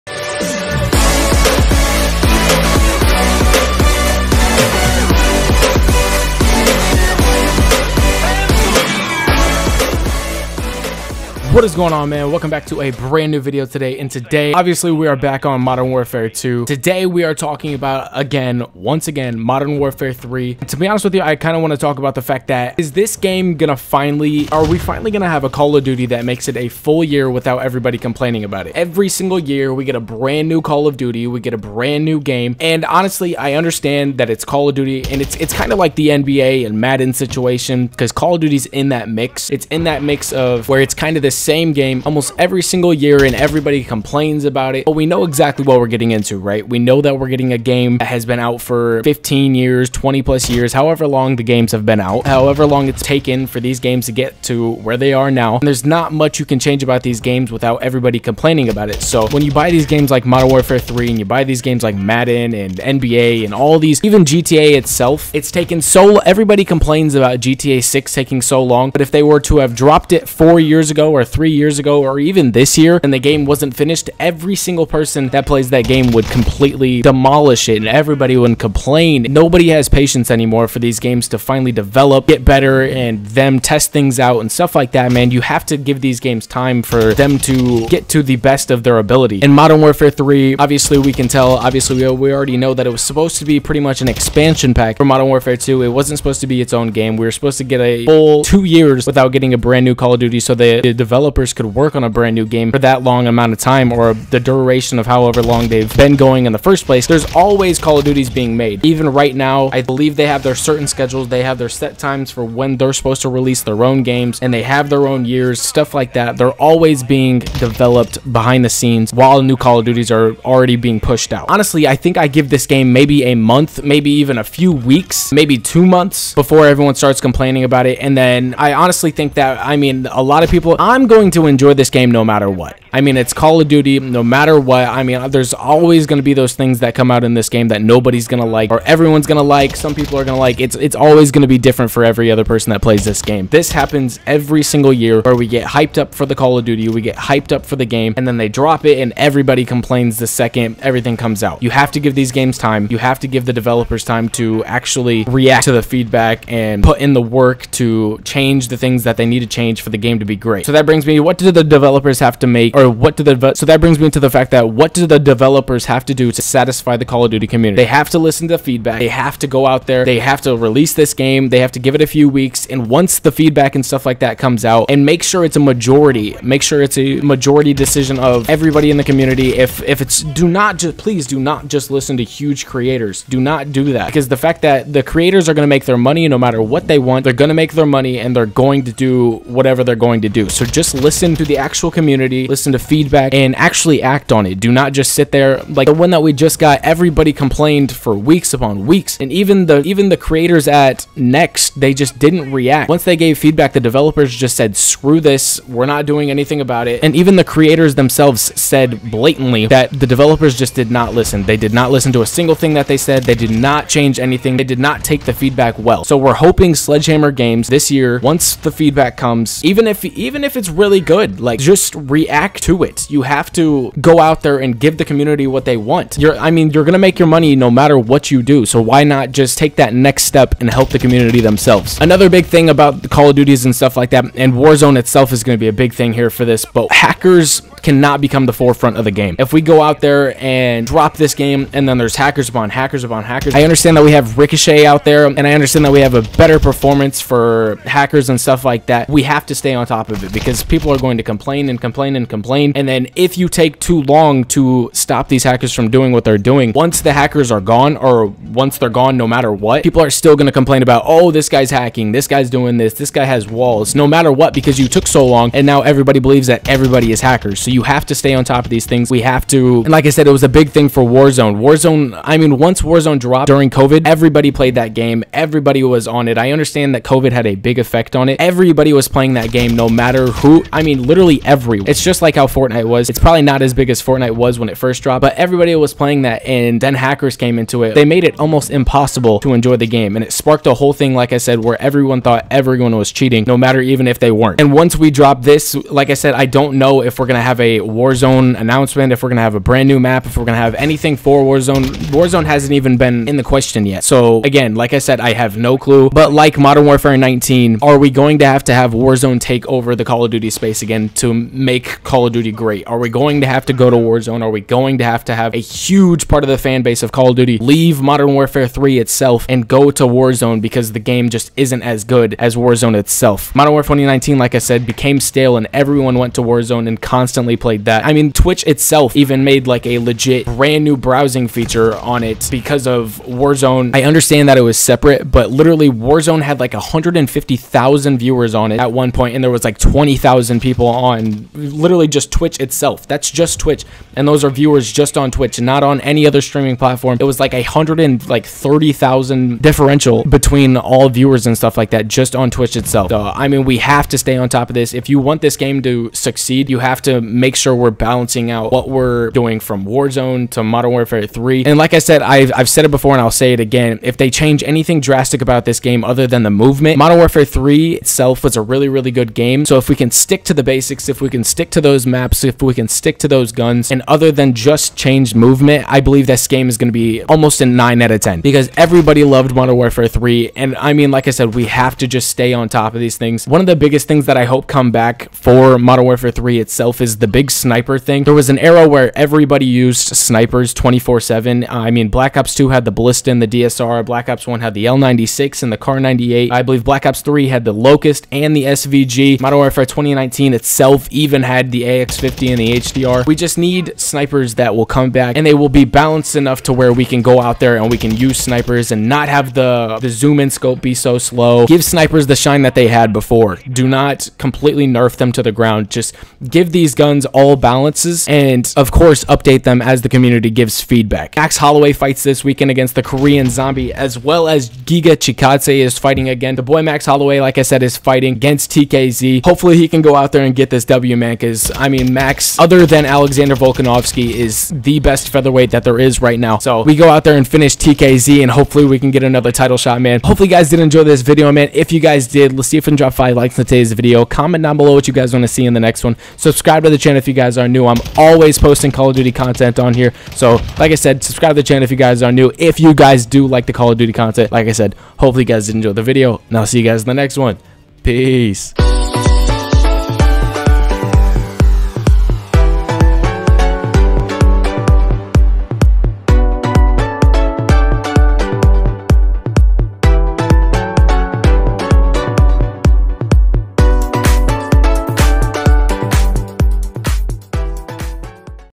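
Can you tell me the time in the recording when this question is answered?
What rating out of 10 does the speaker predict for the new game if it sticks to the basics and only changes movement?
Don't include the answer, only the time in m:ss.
6:17.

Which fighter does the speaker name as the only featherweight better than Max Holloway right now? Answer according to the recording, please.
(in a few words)
Alexander Volkanovski.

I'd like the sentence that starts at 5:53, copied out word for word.
So, I mean, we have to stay on top of this.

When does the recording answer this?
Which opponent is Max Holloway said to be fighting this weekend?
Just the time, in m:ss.
7:03.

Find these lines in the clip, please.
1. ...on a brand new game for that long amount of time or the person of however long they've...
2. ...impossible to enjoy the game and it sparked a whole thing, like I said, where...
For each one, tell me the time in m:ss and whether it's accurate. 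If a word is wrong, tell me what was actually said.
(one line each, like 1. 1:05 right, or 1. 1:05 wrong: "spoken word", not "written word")
1. 1:41 wrong: "duration", not "person"
2. 4:48 right.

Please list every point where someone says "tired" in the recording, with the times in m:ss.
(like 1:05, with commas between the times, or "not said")
not said.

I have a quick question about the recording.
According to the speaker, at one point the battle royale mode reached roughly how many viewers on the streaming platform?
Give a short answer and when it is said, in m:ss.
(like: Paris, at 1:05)
150,000, at 5:36.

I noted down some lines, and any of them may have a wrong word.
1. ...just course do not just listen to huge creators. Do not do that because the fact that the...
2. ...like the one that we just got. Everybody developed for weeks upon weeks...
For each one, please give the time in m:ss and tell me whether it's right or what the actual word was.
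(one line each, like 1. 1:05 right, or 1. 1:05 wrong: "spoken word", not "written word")
1. 3:00 wrong: "please", not "course"
2. 3:15 wrong: "complained", not "developed".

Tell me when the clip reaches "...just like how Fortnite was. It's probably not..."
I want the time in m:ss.
4:42.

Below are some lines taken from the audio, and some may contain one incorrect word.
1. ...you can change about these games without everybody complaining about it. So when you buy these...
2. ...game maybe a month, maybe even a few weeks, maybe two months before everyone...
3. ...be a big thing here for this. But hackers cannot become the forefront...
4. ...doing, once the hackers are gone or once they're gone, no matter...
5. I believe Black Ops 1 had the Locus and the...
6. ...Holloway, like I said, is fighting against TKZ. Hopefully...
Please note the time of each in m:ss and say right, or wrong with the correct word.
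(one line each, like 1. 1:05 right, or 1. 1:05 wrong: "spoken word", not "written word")
1. 0:56 right
2. 2:02 right
3. 3:55 right
4. 4:16 right
5. 6:36 wrong: "3", not "1"
6. 7:07 right.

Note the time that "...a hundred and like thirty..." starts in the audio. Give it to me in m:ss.
5:47.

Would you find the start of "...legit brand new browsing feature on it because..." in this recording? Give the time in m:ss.
5:29.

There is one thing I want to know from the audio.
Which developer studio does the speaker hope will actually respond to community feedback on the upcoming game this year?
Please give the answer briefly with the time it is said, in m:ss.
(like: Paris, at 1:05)
Sledgehammer Games, at 3:36.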